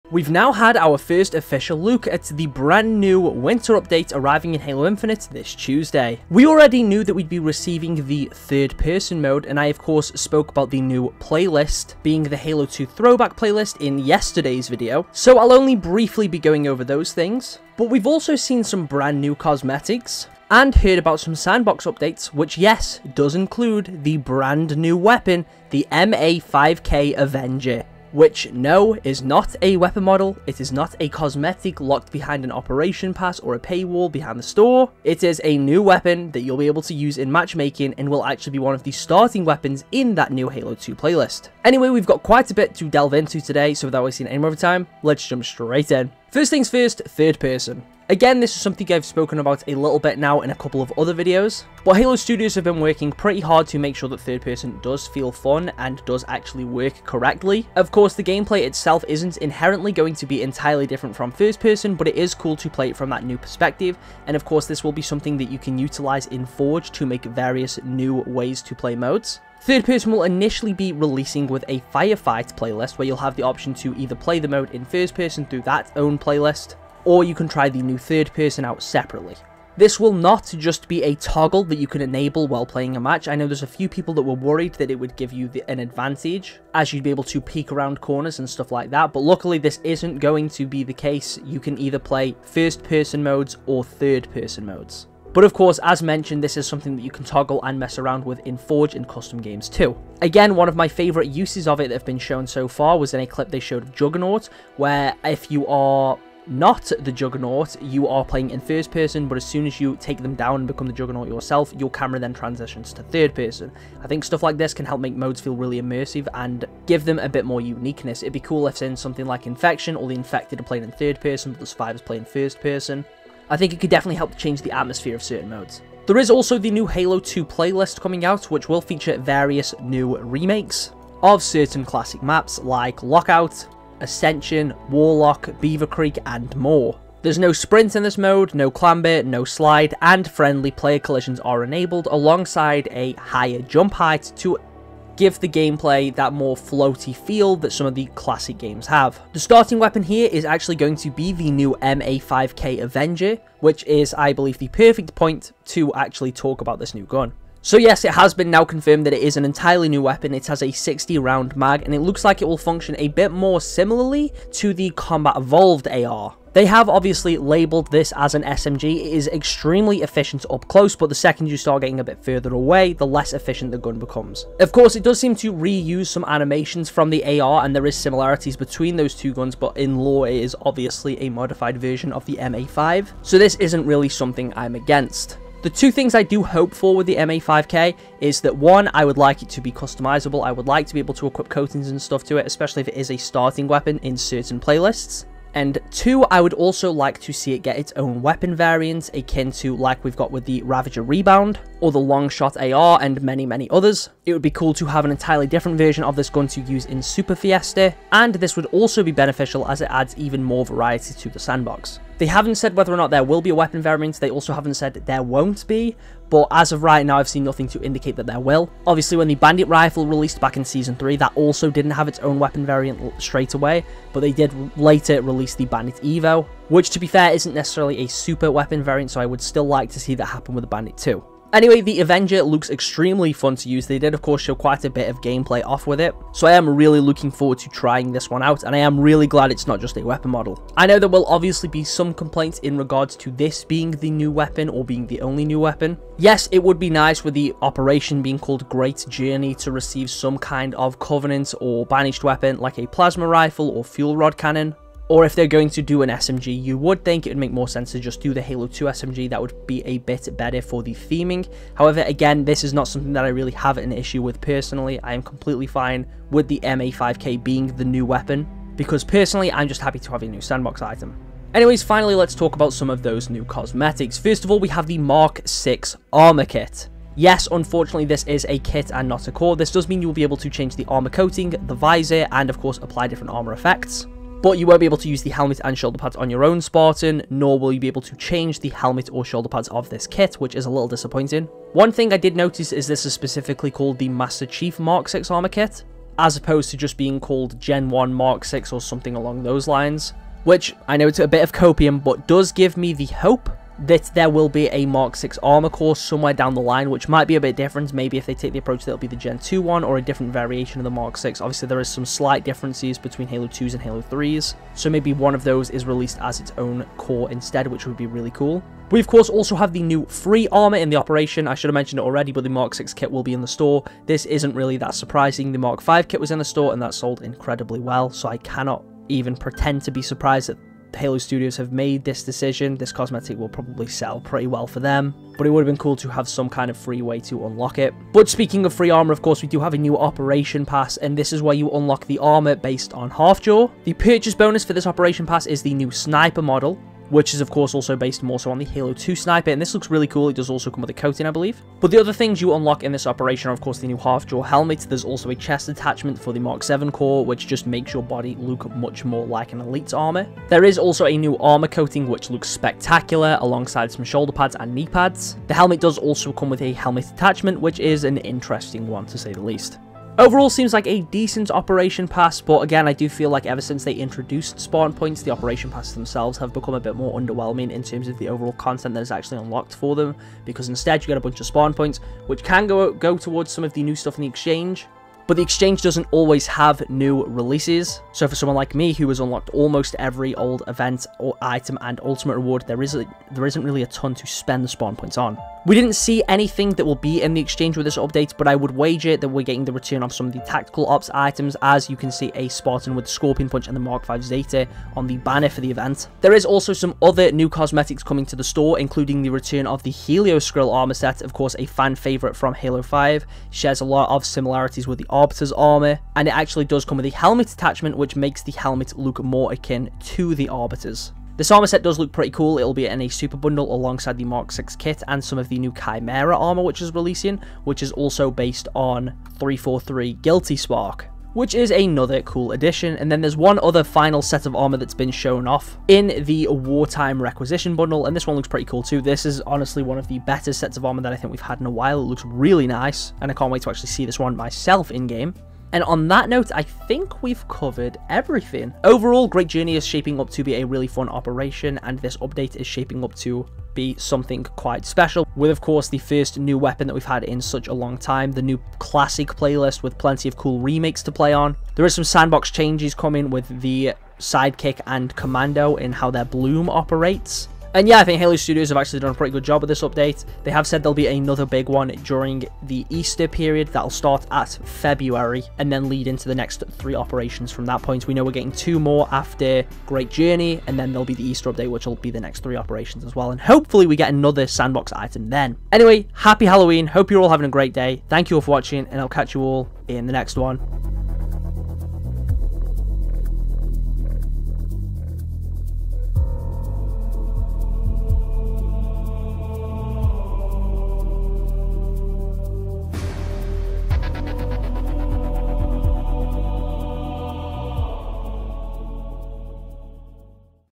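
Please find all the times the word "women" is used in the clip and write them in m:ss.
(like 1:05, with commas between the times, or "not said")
not said.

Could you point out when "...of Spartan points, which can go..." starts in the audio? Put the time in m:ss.
6:21.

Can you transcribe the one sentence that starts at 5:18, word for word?
We, of course, also have the new free armor in the operation.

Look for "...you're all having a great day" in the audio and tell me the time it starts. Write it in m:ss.
8:07.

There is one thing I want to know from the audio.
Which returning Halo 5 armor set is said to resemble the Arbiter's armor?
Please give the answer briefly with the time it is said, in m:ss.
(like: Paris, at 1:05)
Helioskrill, at 6:49.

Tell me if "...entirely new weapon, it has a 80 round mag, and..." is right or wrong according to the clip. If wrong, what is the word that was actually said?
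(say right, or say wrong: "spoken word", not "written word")
wrong: "60", not "80".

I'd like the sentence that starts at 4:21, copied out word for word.
However, again, this is not something that I really have an issue with personally.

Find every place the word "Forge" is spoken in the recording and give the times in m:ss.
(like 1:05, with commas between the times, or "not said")
1:06, 1:38.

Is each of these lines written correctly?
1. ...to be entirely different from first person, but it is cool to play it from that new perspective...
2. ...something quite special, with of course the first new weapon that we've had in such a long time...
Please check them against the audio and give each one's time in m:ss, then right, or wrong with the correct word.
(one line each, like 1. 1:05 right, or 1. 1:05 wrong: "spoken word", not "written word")
1. 1:00 right
2. 7:33 right.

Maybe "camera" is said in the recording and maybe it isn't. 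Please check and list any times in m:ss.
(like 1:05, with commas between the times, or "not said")
1:51.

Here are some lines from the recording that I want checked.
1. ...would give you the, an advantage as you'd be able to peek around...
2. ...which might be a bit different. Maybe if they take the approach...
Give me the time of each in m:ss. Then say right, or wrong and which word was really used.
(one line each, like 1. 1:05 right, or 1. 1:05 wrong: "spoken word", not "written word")
1. 1:24 right
2. 5:06 right.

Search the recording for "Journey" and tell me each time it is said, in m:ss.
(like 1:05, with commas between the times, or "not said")
4:09, 7:29, 8:00.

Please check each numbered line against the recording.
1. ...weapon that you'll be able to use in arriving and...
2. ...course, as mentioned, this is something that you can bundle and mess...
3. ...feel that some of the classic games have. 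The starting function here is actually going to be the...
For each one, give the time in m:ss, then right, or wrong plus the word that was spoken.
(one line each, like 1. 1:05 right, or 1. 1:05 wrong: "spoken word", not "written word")
1. 0:35 wrong: "matchmaking", not "arriving"
2. 1:35 wrong: "toggle", not "bundle"
3. 2:27 wrong: "weapon", not "function".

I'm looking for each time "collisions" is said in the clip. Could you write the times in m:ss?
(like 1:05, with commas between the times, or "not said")
2:20.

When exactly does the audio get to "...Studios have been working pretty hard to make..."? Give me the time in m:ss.
0:52.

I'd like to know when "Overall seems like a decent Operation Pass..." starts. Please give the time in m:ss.
6:10.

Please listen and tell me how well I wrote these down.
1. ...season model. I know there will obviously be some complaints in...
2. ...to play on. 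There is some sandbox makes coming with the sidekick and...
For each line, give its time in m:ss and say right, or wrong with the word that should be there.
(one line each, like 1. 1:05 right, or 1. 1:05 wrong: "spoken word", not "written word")
1. 4:00 wrong: "weapon", not "season"
2. 7:41 wrong: "changes", not "makes".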